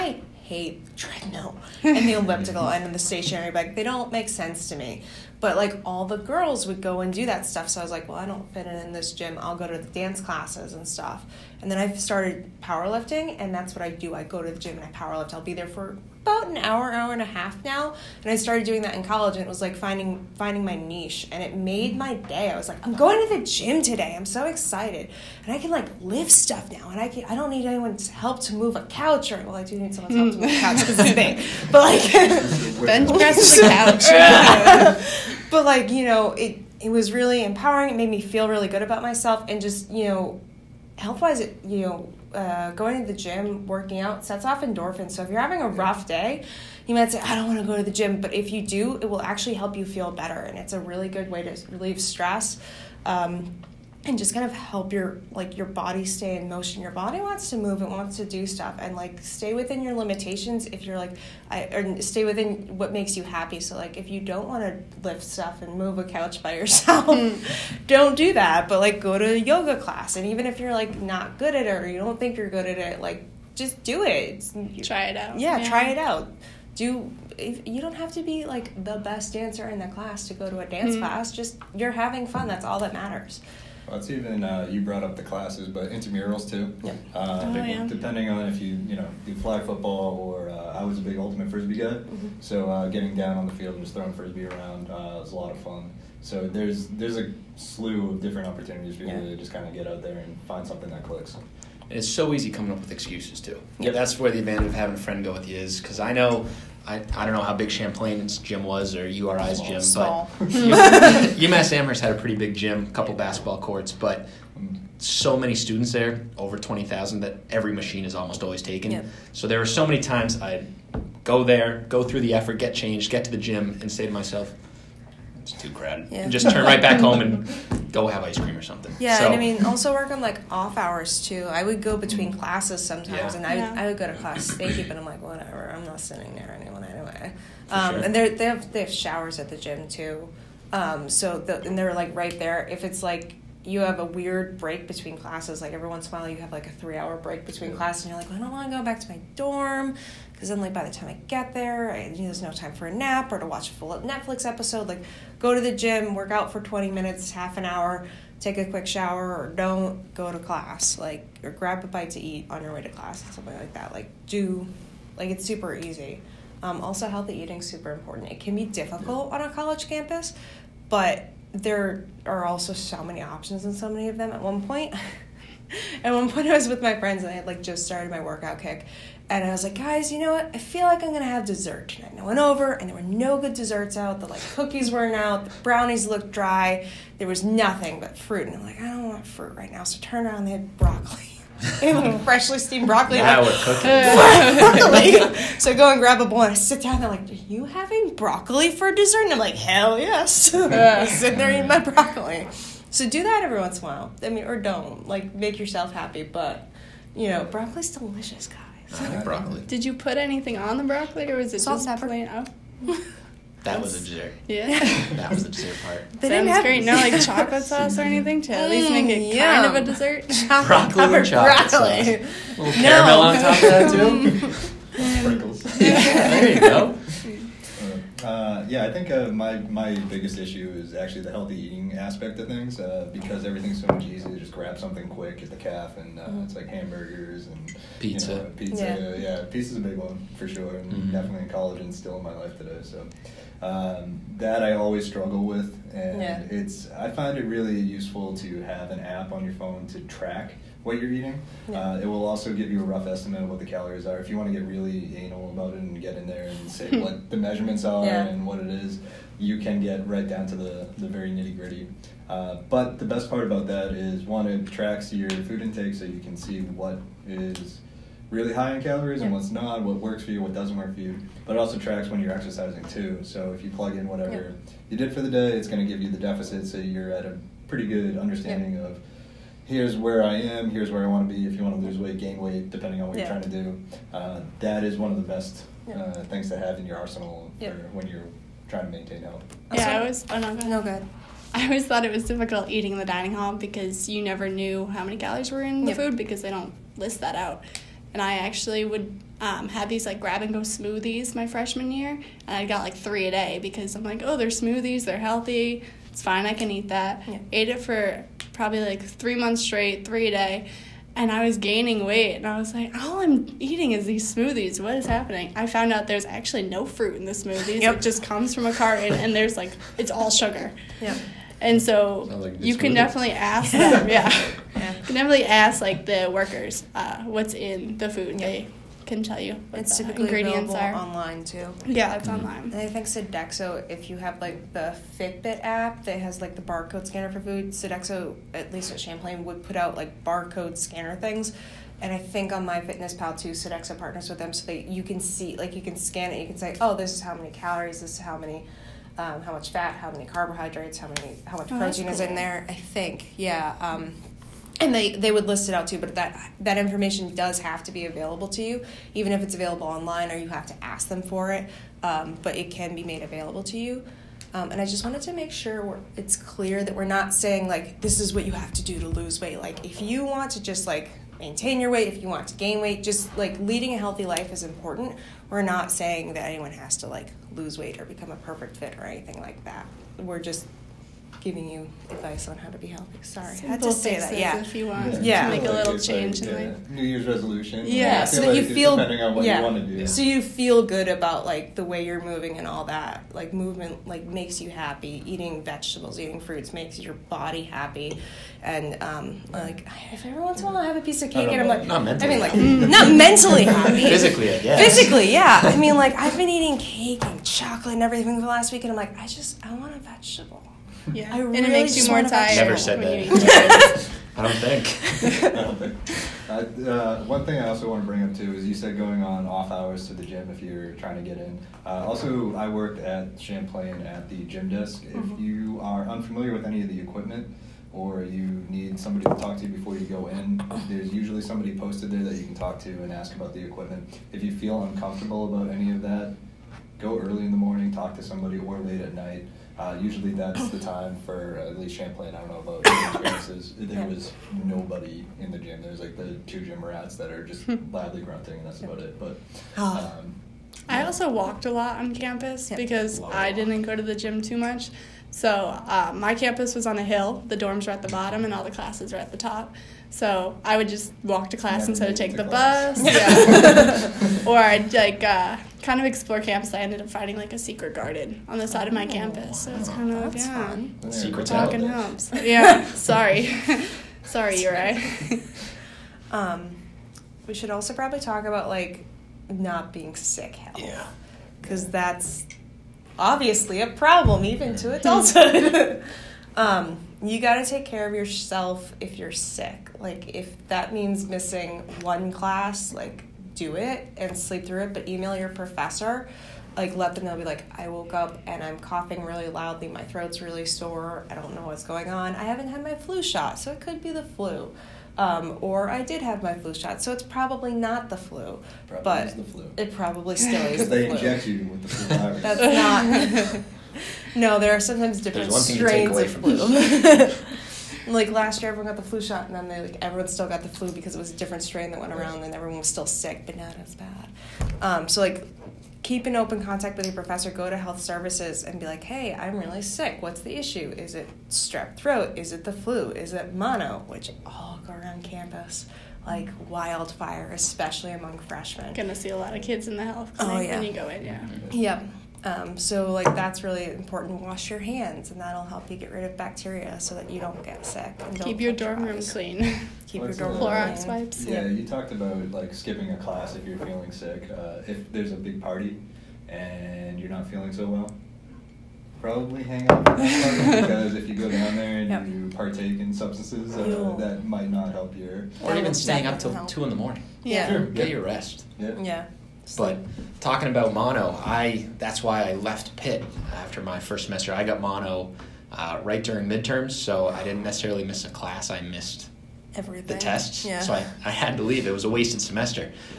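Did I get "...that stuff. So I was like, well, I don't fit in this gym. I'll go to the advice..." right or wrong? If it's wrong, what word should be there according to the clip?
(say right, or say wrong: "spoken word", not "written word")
wrong: "dance", not "advice".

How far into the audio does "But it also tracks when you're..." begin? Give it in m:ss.
4:31.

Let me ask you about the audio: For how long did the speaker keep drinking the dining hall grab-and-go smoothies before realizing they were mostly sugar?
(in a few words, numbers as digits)
3 months.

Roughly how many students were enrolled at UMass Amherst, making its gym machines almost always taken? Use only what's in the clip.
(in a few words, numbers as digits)
Over 20,000.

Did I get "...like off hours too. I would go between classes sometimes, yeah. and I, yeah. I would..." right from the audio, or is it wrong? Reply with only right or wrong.
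right.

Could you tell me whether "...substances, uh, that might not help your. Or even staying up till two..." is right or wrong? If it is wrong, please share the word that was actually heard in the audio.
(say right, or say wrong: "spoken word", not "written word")
right.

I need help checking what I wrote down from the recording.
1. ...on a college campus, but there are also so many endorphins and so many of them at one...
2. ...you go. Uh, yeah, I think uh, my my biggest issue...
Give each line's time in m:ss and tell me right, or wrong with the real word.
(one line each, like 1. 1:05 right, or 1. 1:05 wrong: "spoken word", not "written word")
1. 2:49 wrong: "options", not "endorphins"
2. 3:46 right.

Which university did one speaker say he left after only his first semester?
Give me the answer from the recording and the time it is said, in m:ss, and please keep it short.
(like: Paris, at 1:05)
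Pitt, at 9:32.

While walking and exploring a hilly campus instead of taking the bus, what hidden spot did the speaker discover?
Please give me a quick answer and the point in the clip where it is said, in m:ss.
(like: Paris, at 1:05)
A secret garden, at 7:47.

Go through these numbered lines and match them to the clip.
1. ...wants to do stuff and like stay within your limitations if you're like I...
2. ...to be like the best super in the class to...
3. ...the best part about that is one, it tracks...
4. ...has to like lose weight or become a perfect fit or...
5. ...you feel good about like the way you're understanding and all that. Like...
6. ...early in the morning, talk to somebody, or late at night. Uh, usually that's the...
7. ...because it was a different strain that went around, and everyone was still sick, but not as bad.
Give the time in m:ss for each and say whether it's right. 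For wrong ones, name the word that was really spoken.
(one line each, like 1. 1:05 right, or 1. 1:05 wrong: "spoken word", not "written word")
1. 0:57 right
2. 1:18 wrong: "dancer", not "super"
3. 4:22 right
4. 6:16 right
5. 6:30 wrong: "moving", not "understanding"
6. 7:17 right
7. 8:40 right.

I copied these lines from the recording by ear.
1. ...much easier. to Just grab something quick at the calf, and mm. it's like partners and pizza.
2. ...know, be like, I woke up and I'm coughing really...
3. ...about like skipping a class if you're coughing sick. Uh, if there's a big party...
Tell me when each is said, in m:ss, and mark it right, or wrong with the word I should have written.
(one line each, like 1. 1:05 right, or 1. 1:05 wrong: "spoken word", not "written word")
1. 3:53 wrong: "hamburgers", not "partners"
2. 8:17 right
3. 9:12 wrong: "feeling", not "coughing".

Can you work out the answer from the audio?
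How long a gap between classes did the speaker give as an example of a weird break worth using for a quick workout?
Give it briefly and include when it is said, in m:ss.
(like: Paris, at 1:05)
3 hours, at 2:26.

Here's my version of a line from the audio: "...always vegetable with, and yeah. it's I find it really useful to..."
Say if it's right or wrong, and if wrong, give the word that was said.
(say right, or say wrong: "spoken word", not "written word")
wrong: "struggle", not "vegetable".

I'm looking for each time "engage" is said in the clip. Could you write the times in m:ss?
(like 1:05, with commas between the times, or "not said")
not said.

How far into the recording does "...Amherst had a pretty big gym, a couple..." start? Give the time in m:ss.
1:51.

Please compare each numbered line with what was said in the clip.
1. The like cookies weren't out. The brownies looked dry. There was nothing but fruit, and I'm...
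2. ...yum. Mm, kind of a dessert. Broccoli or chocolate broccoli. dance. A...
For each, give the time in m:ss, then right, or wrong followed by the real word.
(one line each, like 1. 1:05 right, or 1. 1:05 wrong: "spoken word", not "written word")
1. 3:04 right
2. 3:39 wrong: "sauce", not "dance".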